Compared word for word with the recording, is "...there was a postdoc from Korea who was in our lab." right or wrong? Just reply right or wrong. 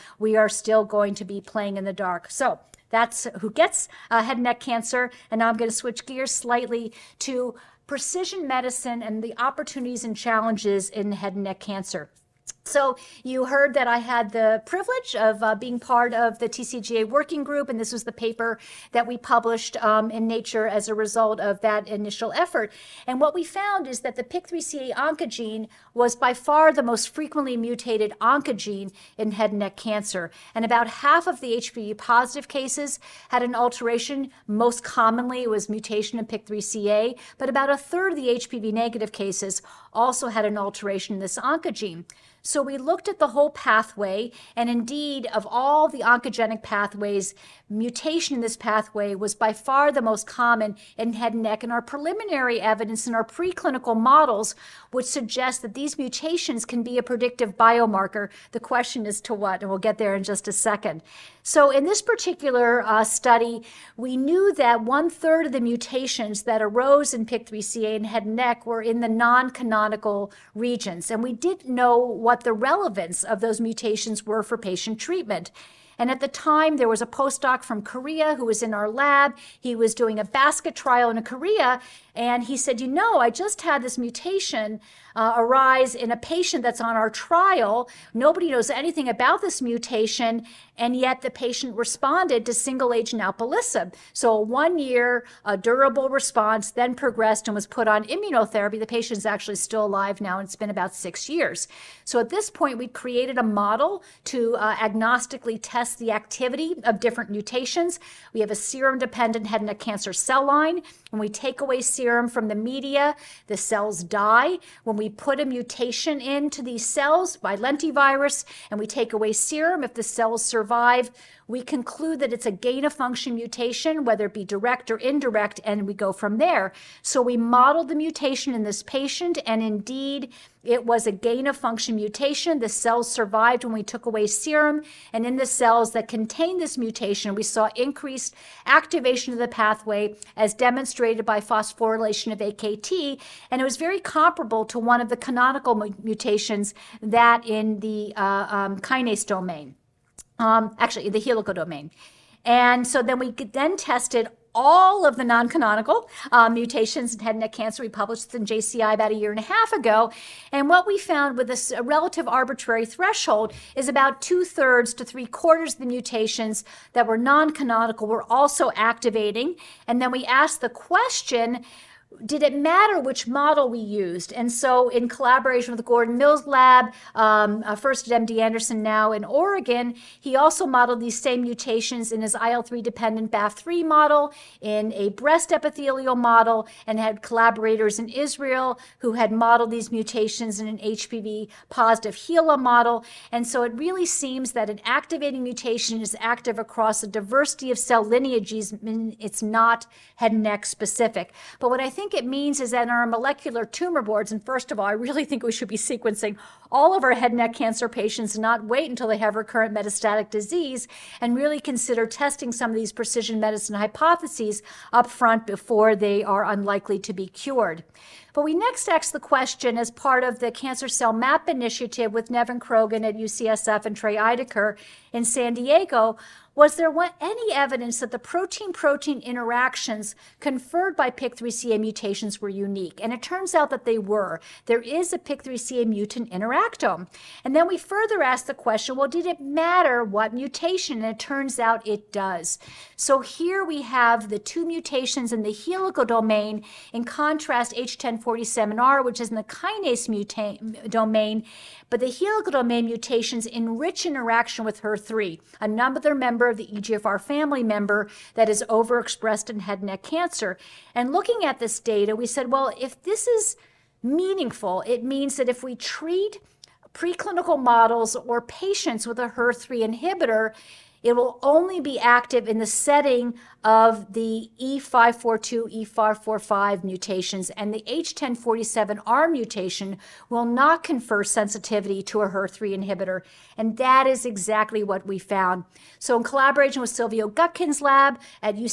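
right.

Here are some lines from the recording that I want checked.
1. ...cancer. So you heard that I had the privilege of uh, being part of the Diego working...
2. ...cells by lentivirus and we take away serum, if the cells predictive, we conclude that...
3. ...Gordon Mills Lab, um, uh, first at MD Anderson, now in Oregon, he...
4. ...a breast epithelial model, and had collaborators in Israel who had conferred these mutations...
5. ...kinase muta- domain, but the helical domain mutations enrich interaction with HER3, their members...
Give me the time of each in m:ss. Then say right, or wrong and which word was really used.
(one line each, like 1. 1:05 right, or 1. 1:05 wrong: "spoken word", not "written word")
1. 0:11 wrong: "TCGA", not "Diego"
2. 1:56 wrong: "survive", not "predictive"
3. 2:55 right
4. 3:04 wrong: "modeled", not "conferred"
5. 4:09 right.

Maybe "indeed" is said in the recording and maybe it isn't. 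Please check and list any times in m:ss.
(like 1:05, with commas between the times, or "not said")
0:44, 2:09.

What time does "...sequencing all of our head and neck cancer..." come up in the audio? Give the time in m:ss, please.
3:25.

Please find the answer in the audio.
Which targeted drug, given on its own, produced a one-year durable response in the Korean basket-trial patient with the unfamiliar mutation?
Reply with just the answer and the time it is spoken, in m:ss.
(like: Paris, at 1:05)
alpelisib, at 1:33.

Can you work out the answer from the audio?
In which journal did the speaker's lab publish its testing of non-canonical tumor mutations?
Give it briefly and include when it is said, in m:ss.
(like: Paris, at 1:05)
JCI, at 2:38.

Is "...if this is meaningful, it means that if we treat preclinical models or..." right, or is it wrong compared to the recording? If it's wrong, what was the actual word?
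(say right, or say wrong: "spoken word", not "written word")
right.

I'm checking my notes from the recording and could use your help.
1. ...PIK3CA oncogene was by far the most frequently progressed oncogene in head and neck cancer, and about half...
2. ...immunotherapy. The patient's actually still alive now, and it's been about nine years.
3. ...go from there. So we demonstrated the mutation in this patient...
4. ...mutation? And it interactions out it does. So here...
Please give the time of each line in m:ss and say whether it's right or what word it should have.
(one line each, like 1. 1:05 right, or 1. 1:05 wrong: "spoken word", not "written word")
1. 0:24 wrong: "mutated", not "progressed"
2. 1:38 wrong: "six", not "nine"
3. 2:05 wrong: "modeled", not "demonstrated"
4. 4:00 wrong: "turns", not "interactions".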